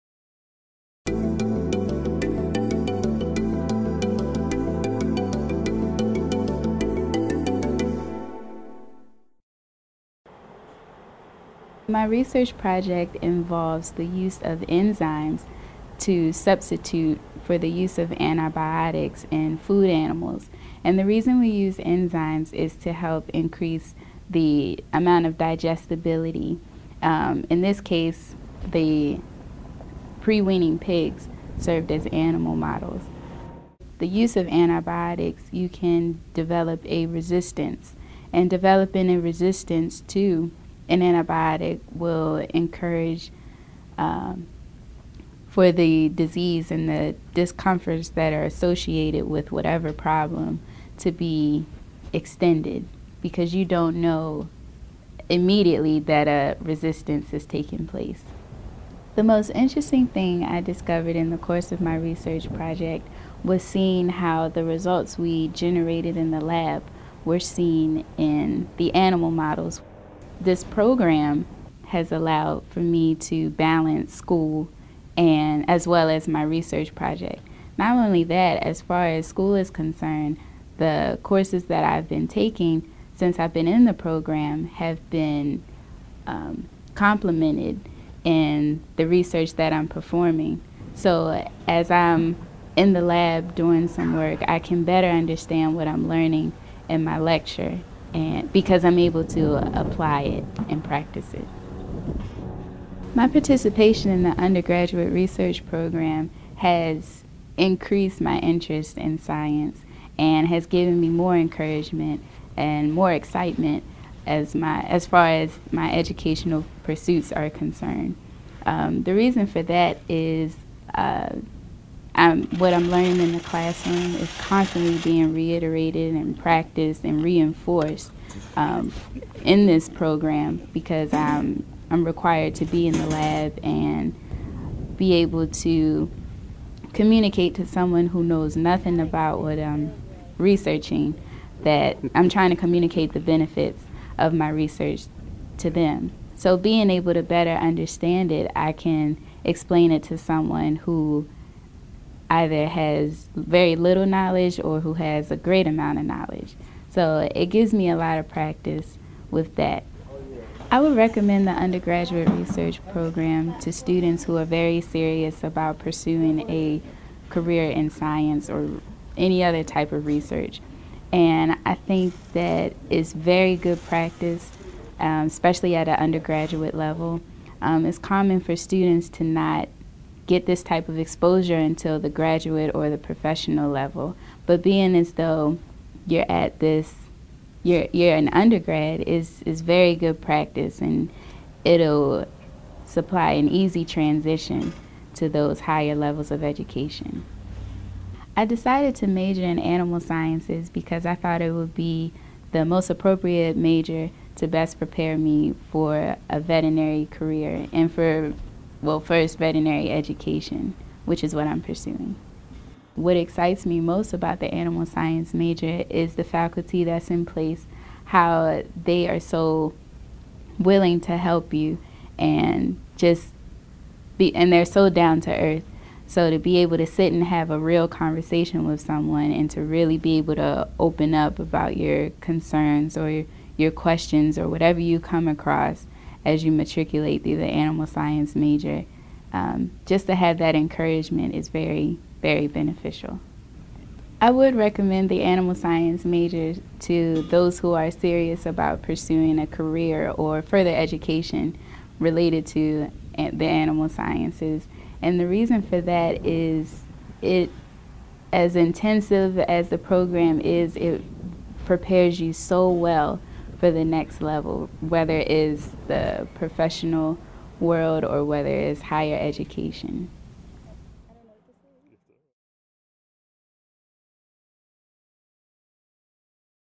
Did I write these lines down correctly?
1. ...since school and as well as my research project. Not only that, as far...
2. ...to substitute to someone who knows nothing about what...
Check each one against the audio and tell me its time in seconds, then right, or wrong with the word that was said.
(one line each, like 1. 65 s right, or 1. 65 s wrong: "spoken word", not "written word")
1. 73 s wrong: "balance", not "since"
2. 135 s wrong: "communicate", not "substitute".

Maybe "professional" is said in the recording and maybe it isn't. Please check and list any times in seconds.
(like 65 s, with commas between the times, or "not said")
182 s, 266 s.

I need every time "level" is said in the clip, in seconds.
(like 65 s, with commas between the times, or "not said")
176 s, 183 s, 195 s, 264 s.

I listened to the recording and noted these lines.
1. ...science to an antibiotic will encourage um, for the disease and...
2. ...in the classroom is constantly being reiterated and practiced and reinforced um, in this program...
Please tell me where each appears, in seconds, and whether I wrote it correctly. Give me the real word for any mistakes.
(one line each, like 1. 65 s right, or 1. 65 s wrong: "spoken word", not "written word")
1. 39 s wrong: "resistance", not "science"
2. 123 s right.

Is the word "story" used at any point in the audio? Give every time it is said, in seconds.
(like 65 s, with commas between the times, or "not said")
not said.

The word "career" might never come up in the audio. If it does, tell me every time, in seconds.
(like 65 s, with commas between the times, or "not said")
167 s, 207 s, 249 s.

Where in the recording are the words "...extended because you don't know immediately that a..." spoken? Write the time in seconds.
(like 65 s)
52 s.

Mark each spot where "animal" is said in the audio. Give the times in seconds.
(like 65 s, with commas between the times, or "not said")
19 s, 32 s, 68 s, 199 s, 214 s, 237 s, 245 s, 253 s.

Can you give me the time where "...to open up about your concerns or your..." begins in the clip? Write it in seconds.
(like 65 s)
230 s.